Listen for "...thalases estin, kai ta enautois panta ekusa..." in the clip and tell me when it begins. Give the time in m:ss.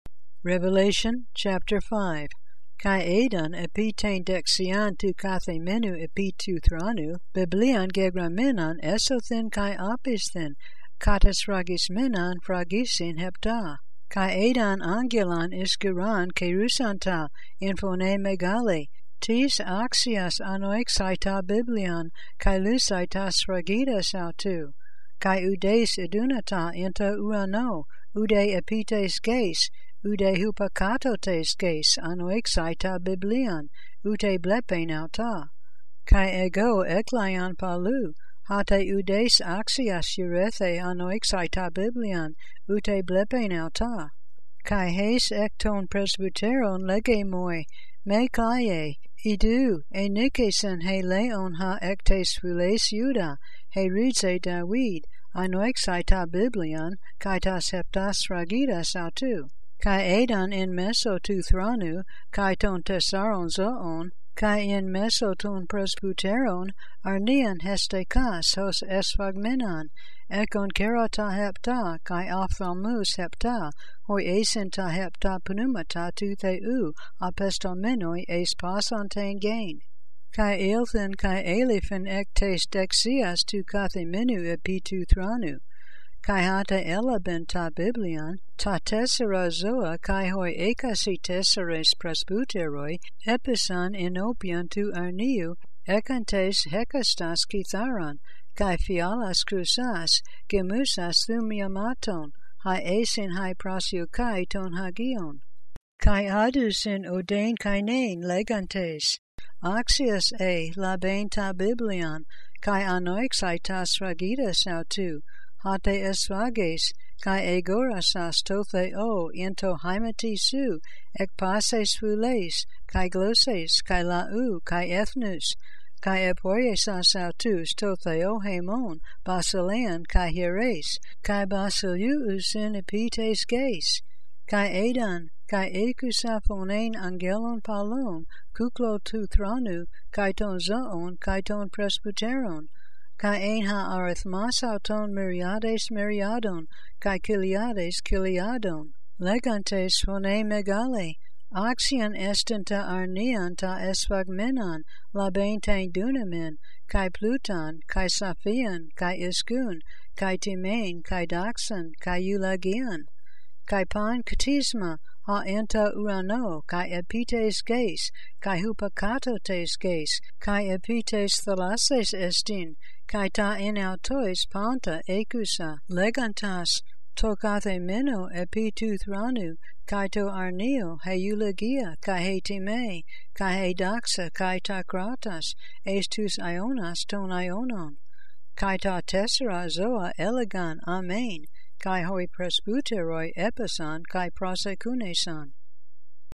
2:51.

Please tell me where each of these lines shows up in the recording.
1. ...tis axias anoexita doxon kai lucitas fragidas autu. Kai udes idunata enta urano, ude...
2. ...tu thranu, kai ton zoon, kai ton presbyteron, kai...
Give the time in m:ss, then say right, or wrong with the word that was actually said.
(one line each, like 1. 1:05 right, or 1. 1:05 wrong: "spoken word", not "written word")
1. 0:19 wrong: "biblion", not "doxon"
2. 2:19 right.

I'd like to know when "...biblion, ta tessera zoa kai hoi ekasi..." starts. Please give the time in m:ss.
1:27.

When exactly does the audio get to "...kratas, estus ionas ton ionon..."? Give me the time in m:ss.
3:04.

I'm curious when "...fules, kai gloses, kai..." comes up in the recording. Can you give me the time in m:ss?
2:01.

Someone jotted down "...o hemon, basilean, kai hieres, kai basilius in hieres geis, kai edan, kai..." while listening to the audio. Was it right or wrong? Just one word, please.
wrong.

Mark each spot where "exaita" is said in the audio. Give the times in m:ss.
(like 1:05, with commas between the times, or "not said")
0:32, 0:41, 0:55.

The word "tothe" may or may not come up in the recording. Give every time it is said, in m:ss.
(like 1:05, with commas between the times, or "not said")
1:58, 2:07.